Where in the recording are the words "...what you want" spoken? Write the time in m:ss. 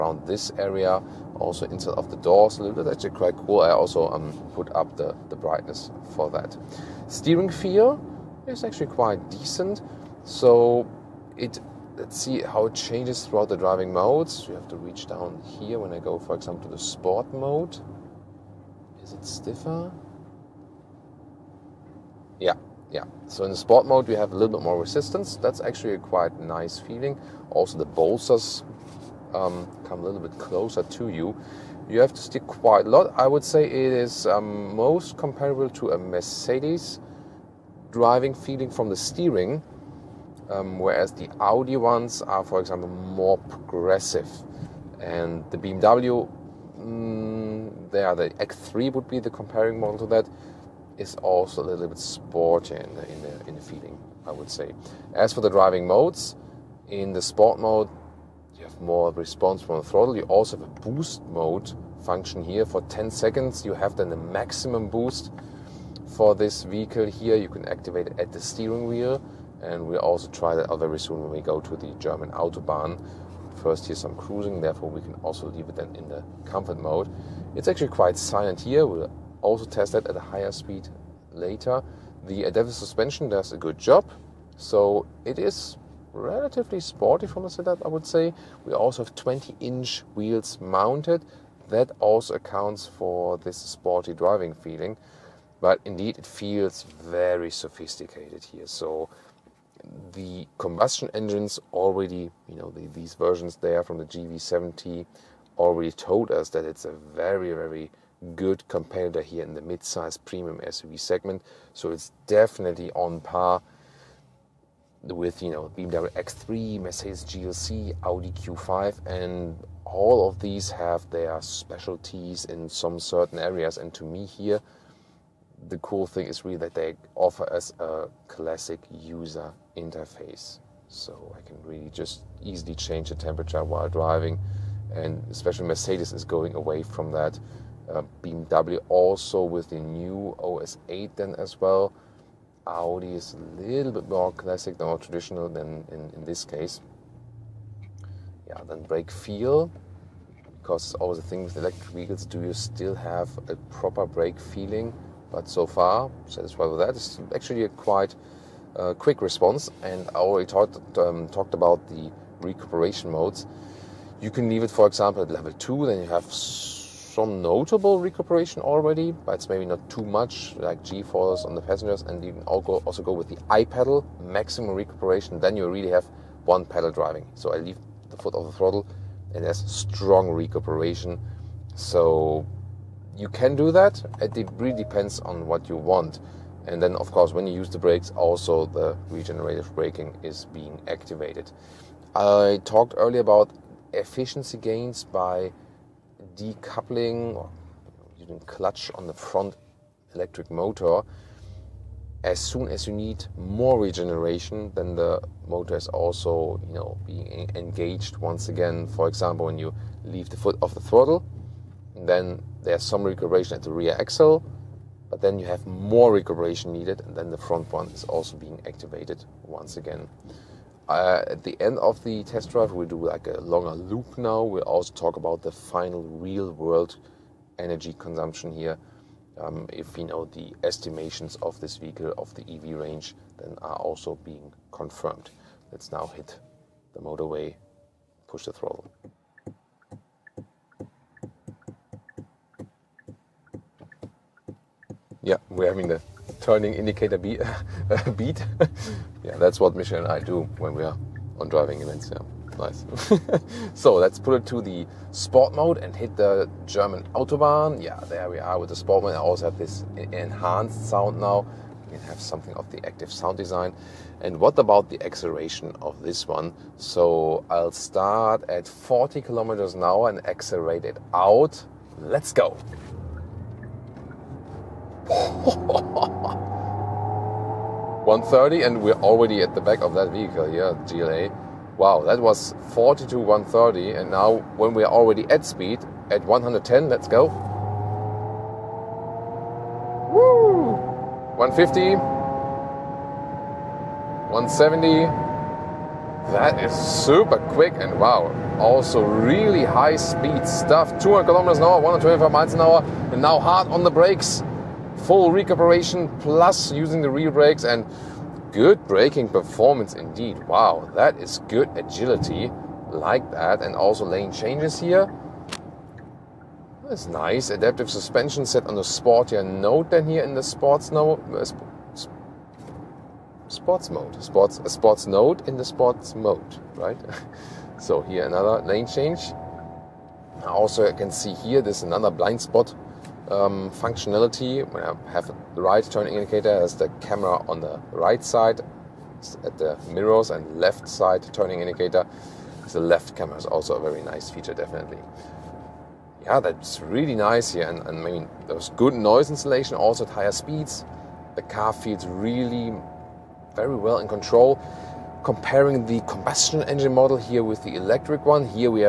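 3:05.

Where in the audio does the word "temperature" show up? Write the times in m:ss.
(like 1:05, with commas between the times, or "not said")
2:13.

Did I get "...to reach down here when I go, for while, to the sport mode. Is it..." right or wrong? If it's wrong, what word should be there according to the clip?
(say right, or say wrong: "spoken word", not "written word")
wrong: "example", not "while".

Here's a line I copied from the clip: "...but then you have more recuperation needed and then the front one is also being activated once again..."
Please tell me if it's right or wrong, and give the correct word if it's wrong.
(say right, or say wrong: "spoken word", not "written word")
right.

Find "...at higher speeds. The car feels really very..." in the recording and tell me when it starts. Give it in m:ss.
5:50.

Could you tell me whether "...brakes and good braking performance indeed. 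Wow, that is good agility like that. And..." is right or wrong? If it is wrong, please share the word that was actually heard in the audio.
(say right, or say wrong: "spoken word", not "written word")
right.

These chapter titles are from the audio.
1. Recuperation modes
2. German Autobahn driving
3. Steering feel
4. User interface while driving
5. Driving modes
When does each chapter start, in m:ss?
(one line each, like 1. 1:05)
1. 2:42
2. 4:12
3. 0:05
4. 2:02
5. 0:55.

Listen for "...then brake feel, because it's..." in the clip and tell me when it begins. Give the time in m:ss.
2:28.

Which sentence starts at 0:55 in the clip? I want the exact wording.
As for the driving modes, in the sport mode, you have more response from the throttle.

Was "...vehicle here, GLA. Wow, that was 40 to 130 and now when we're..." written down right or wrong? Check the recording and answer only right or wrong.
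right.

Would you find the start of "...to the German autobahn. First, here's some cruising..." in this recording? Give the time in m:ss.
1:11.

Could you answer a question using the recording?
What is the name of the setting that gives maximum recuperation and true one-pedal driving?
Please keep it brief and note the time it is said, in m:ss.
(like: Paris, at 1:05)
i-Pedal, at 2:53.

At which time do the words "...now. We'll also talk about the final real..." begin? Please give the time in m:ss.
3:44.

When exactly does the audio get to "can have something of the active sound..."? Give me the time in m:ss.
4:21.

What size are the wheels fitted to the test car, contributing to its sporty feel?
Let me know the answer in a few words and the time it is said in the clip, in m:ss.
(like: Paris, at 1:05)
20 inch, at 1:29.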